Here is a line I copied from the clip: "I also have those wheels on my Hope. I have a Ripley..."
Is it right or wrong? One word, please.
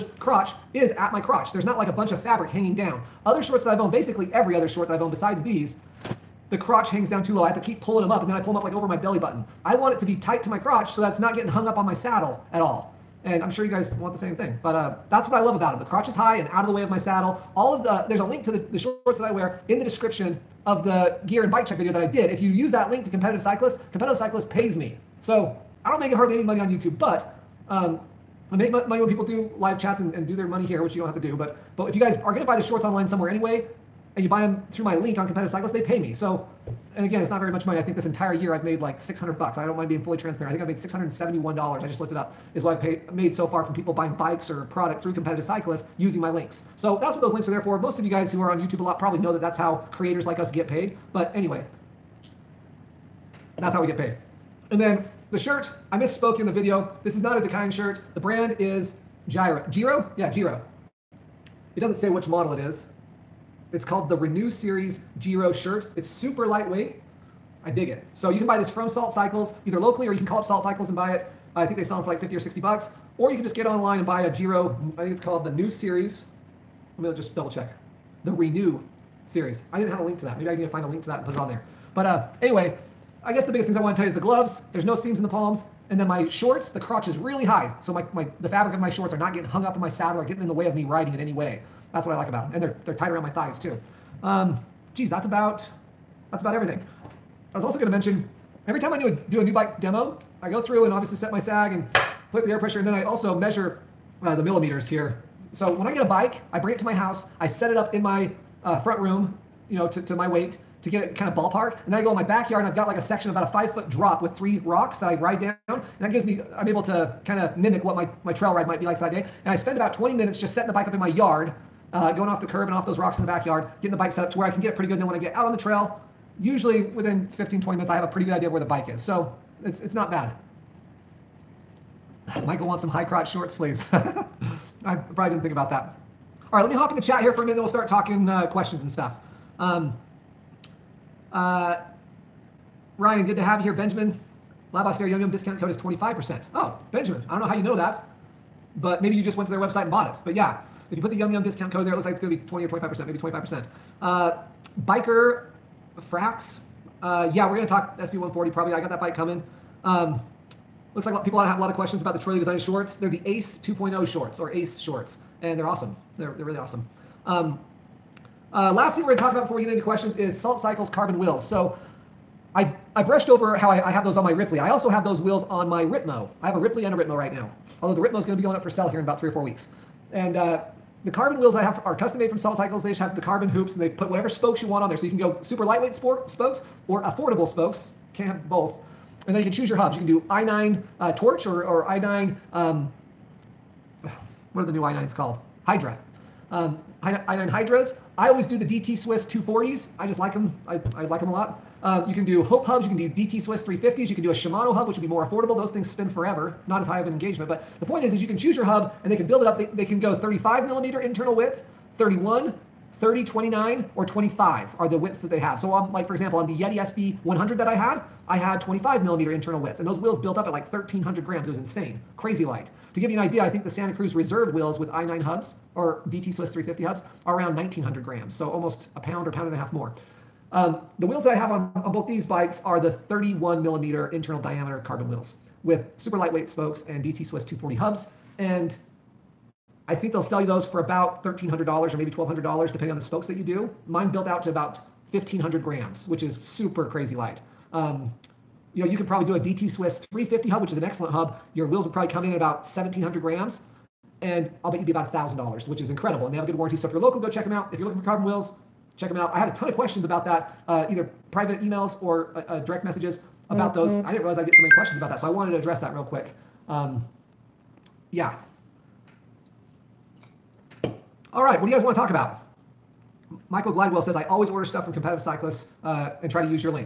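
wrong.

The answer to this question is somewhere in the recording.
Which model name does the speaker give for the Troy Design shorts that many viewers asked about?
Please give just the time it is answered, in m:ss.
2:43.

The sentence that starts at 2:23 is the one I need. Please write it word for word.
Benjamin, Lab Austere Yum Yum discount code is 25%.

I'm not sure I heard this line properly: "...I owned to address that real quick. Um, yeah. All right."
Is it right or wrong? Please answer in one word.
wrong.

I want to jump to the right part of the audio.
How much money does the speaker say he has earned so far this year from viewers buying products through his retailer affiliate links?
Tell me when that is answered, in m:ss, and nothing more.
0:40.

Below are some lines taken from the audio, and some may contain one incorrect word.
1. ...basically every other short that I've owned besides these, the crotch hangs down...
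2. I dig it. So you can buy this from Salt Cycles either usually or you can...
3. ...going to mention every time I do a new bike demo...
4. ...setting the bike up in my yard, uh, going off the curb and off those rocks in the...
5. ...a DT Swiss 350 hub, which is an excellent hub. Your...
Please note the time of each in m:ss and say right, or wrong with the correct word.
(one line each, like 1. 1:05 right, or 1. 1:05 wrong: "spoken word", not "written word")
1. 0:03 right
2. 1:07 wrong: "locally", not "usually"
3. 1:37 right
4. 2:00 right
5. 4:09 right.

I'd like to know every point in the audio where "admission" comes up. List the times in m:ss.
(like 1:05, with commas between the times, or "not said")
not said.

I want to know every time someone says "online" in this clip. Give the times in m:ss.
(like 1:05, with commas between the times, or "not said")
0:32, 1:13.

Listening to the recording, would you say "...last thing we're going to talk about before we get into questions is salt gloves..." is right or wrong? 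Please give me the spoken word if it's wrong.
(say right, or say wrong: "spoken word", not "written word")
wrong: "cycles", not "gloves".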